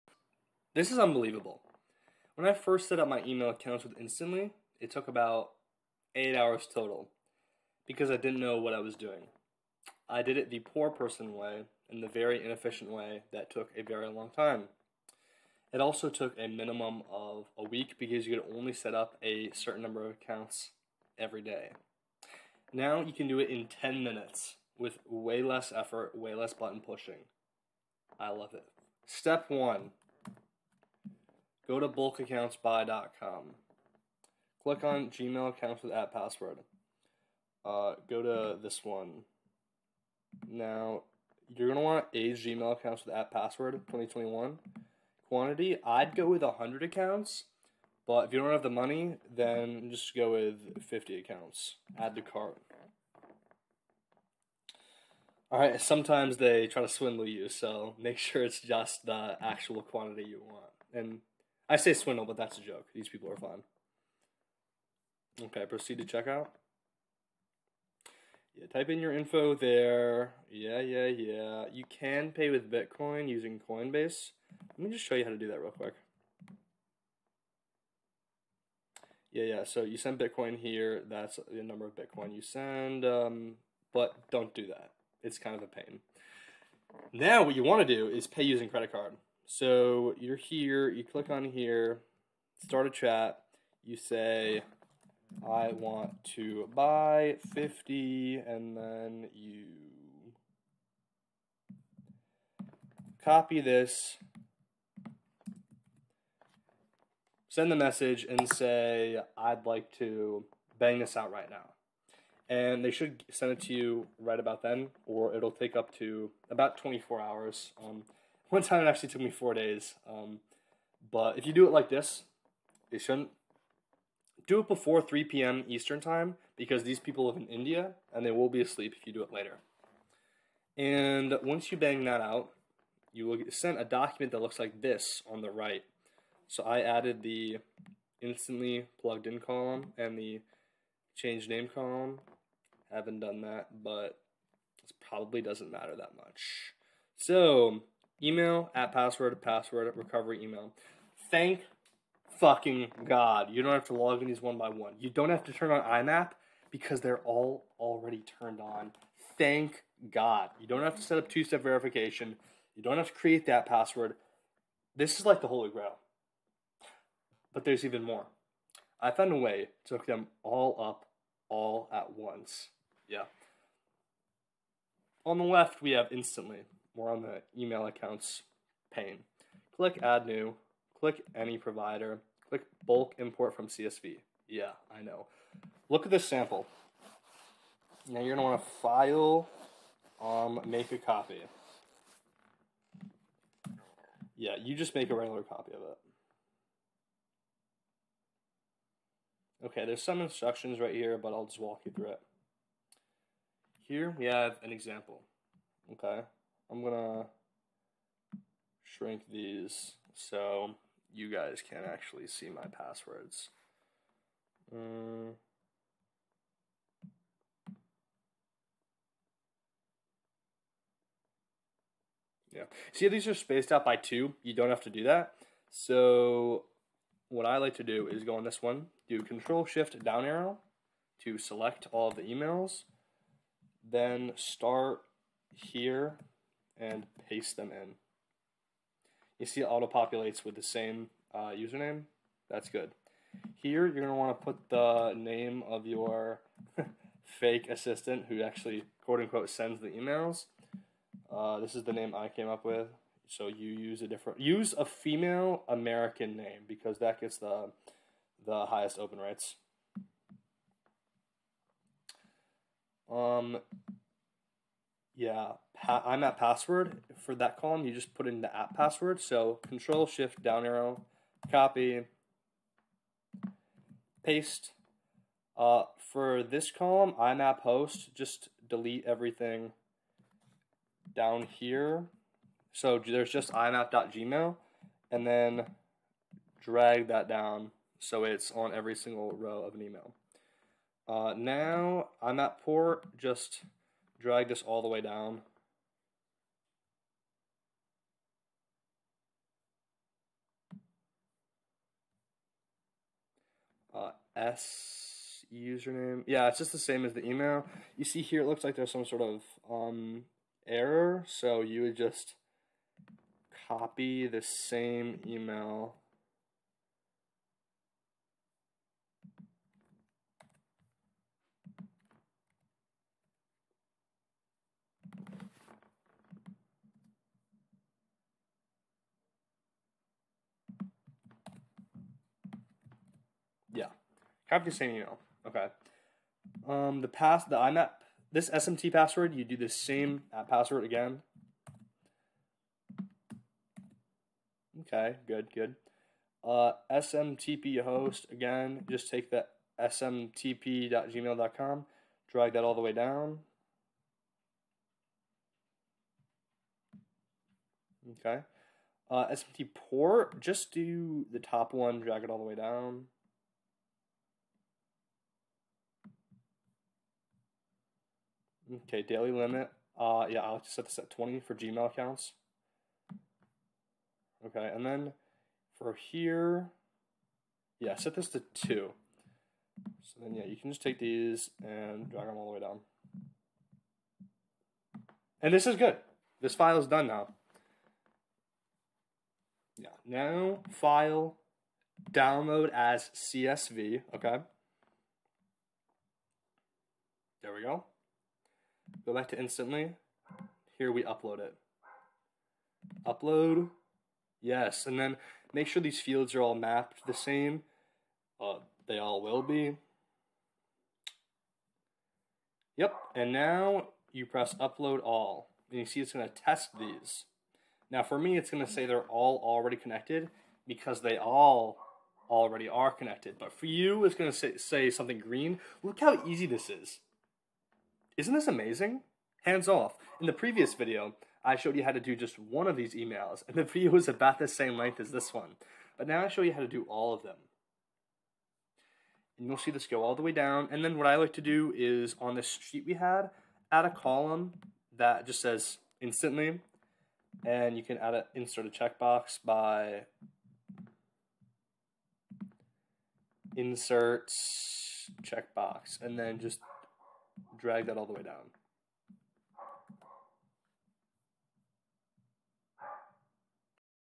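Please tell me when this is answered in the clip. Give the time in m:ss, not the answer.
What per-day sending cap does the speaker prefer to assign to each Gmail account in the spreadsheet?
6:11.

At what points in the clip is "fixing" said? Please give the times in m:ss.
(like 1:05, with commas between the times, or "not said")
not said.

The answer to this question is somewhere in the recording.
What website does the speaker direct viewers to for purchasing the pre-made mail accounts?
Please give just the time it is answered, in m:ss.
0:31.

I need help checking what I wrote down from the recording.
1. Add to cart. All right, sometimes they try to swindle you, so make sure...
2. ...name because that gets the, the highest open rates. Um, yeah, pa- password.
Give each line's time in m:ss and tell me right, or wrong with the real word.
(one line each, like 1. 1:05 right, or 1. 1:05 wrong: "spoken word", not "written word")
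1. 0:51 right
2. 4:16 right.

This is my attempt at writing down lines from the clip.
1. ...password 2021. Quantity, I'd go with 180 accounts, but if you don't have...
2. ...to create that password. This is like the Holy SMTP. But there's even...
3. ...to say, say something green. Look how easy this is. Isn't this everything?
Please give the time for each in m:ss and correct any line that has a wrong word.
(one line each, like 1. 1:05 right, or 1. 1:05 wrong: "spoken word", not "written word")
1. 0:43 wrong: "100", not "180"
2. 2:43 wrong: "Grail", not "SMTP"
3. 7:04 wrong: "amazing", not "everything".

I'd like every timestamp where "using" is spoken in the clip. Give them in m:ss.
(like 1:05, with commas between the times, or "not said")
1:13, 1:28.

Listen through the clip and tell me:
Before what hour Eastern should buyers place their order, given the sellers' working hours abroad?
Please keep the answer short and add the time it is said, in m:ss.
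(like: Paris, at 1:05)
3 p.m., at 2:05.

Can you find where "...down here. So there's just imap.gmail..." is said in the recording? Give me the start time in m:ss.
4:41.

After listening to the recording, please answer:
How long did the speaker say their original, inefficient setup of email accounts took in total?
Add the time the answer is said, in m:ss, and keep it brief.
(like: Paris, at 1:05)
8 hours, at 0:06.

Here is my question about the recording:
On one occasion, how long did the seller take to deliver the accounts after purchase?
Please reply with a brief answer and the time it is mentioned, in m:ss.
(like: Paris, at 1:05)
4 days, at 1:59.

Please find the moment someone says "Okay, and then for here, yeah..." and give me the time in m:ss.
6:14.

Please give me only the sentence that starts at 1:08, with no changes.
Yeah, type in your info there.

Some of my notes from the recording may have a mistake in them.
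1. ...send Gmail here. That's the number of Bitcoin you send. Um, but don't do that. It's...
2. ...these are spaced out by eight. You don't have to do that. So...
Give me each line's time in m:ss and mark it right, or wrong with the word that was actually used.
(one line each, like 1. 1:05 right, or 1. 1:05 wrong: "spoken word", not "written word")
1. 1:19 wrong: "Bitcoin", not "Gmail"
2. 3:43 wrong: "two", not "eight".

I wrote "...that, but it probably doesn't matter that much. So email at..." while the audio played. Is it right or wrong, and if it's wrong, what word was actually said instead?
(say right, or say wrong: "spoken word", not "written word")
right.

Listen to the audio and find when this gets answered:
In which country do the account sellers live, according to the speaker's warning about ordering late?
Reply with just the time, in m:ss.
2:07.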